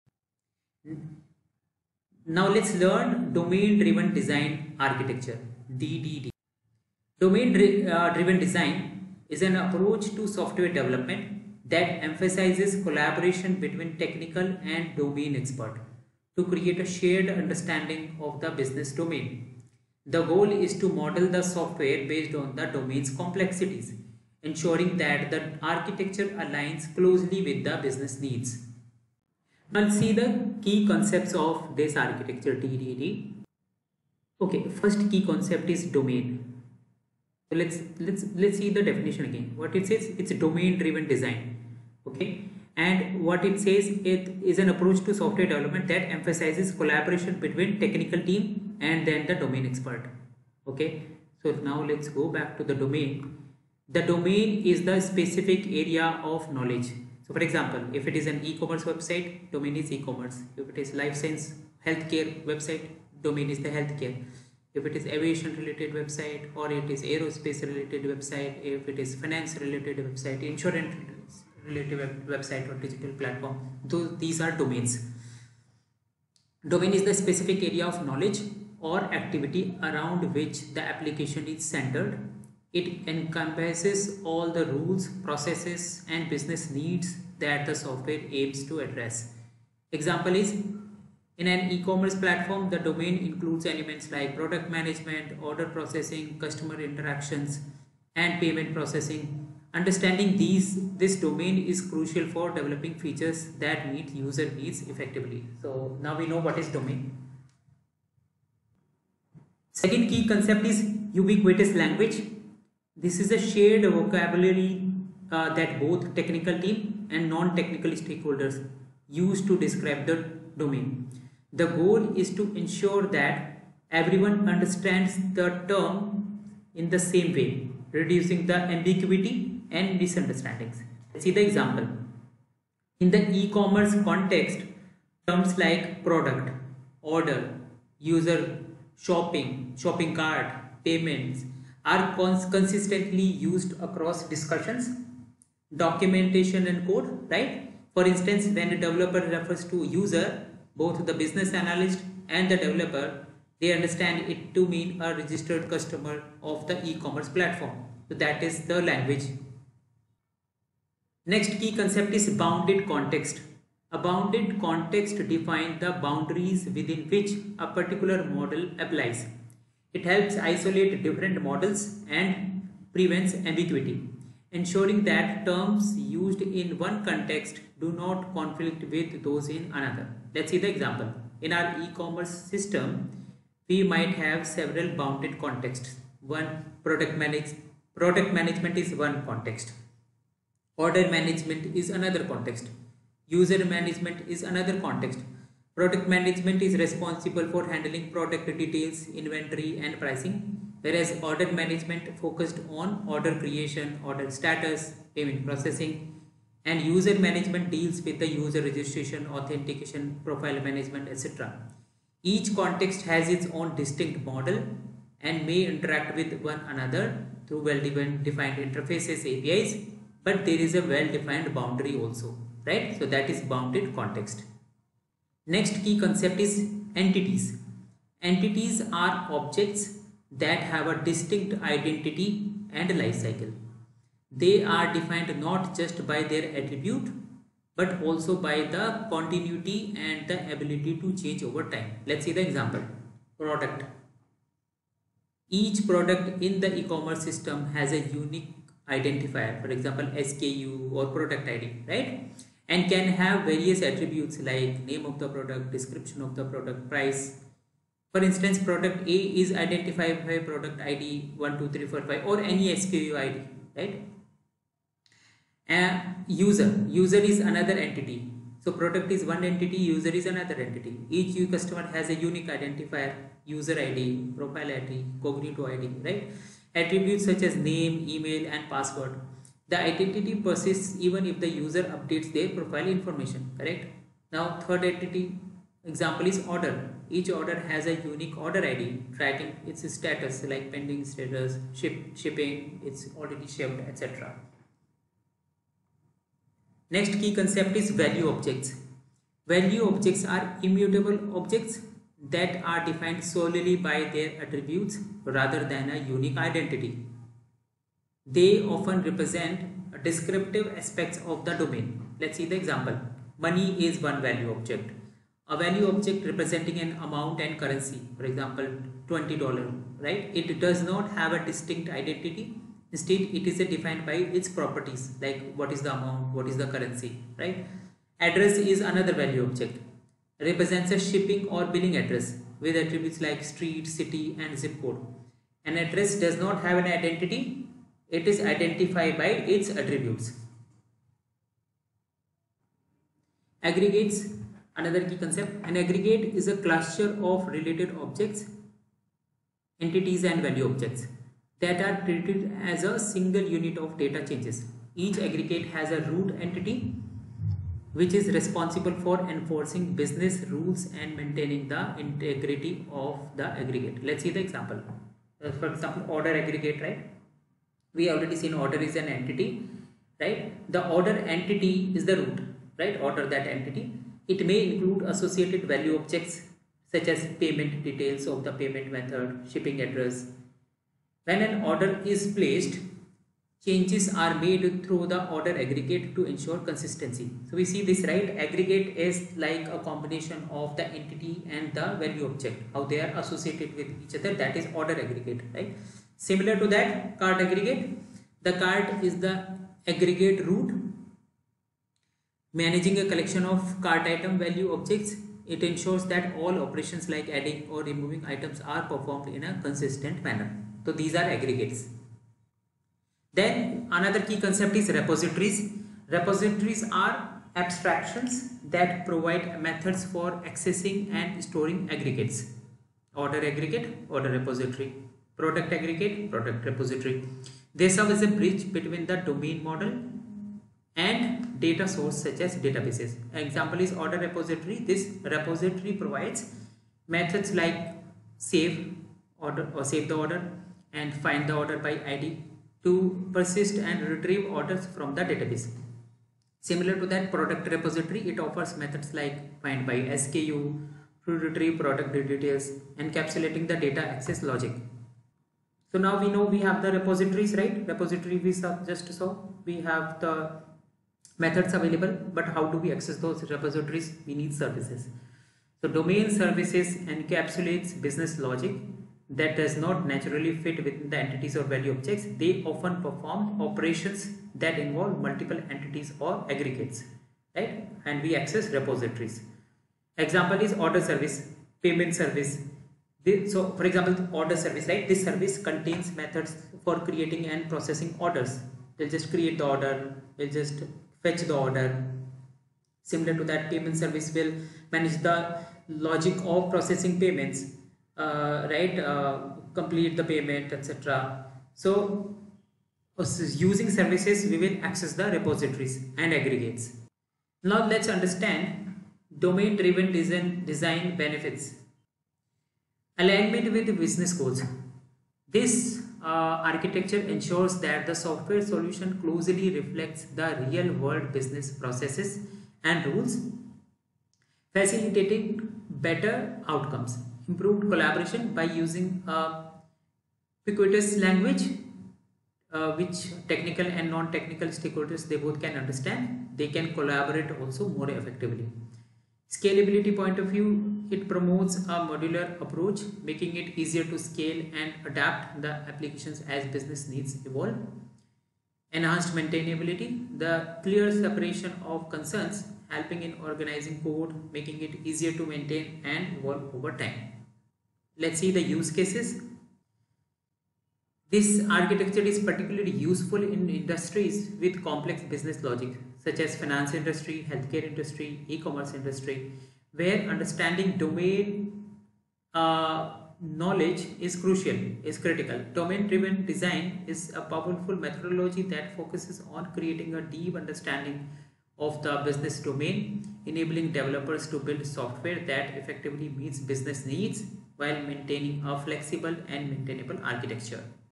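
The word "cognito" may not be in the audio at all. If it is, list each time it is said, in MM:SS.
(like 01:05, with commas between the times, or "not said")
04:35.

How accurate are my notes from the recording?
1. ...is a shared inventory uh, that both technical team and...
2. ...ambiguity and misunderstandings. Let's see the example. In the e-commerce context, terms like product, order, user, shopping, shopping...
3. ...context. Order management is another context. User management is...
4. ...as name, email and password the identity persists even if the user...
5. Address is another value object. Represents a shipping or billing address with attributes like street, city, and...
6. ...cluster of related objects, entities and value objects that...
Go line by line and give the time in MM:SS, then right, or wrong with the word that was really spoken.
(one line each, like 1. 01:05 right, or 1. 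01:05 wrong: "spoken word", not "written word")
1. 01:53 wrong: "vocabulary", not "inventory"
2. 02:08 right
3. 03:09 right
4. 04:37 right
5. 05:28 right
6. 05:46 right.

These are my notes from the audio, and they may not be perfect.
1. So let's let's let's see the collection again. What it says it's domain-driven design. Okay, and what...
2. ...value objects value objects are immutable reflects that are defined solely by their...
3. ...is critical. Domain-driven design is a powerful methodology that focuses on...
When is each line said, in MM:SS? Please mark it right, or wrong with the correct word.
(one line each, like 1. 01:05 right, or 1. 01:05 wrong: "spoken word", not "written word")
1. 00:37 wrong: "definition", not "collection"
2. 04:58 wrong: "objects", not "reflects"
3. 09:35 right.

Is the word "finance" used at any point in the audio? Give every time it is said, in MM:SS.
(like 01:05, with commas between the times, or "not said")
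01:09, 09:26.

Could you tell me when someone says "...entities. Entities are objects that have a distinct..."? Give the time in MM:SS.
03:46.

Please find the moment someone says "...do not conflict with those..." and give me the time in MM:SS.
02:57.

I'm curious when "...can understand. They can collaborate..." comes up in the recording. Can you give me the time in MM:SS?
08:55.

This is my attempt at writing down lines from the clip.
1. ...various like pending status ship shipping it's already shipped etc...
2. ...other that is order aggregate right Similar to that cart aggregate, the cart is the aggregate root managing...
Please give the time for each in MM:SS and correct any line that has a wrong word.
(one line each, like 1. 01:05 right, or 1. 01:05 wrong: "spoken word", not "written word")
1. 04:49 wrong: "status", not "various"
2. 06:34 right.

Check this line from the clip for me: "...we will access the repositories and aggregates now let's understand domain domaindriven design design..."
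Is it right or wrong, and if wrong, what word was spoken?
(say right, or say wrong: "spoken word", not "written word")
wrong: "driven", not "domaindriven".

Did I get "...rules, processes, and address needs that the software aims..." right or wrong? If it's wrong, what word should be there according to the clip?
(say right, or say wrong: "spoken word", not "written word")
wrong: "business", not "address".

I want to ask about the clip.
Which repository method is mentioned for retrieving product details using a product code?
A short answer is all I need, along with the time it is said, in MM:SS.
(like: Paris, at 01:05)
find by SKU, at 07:29.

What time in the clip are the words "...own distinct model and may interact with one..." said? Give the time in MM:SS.
03:33.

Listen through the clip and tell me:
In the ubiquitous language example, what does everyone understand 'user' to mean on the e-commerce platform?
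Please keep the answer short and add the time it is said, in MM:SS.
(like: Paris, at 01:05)
registered customer, at 02:35.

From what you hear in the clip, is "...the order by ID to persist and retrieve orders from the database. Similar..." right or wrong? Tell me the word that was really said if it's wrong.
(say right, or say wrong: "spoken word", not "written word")
right.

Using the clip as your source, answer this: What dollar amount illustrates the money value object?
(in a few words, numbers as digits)
$20.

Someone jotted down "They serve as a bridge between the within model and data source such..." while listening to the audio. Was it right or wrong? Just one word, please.
wrong.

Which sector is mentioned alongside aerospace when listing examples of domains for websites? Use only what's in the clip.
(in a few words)
aviation.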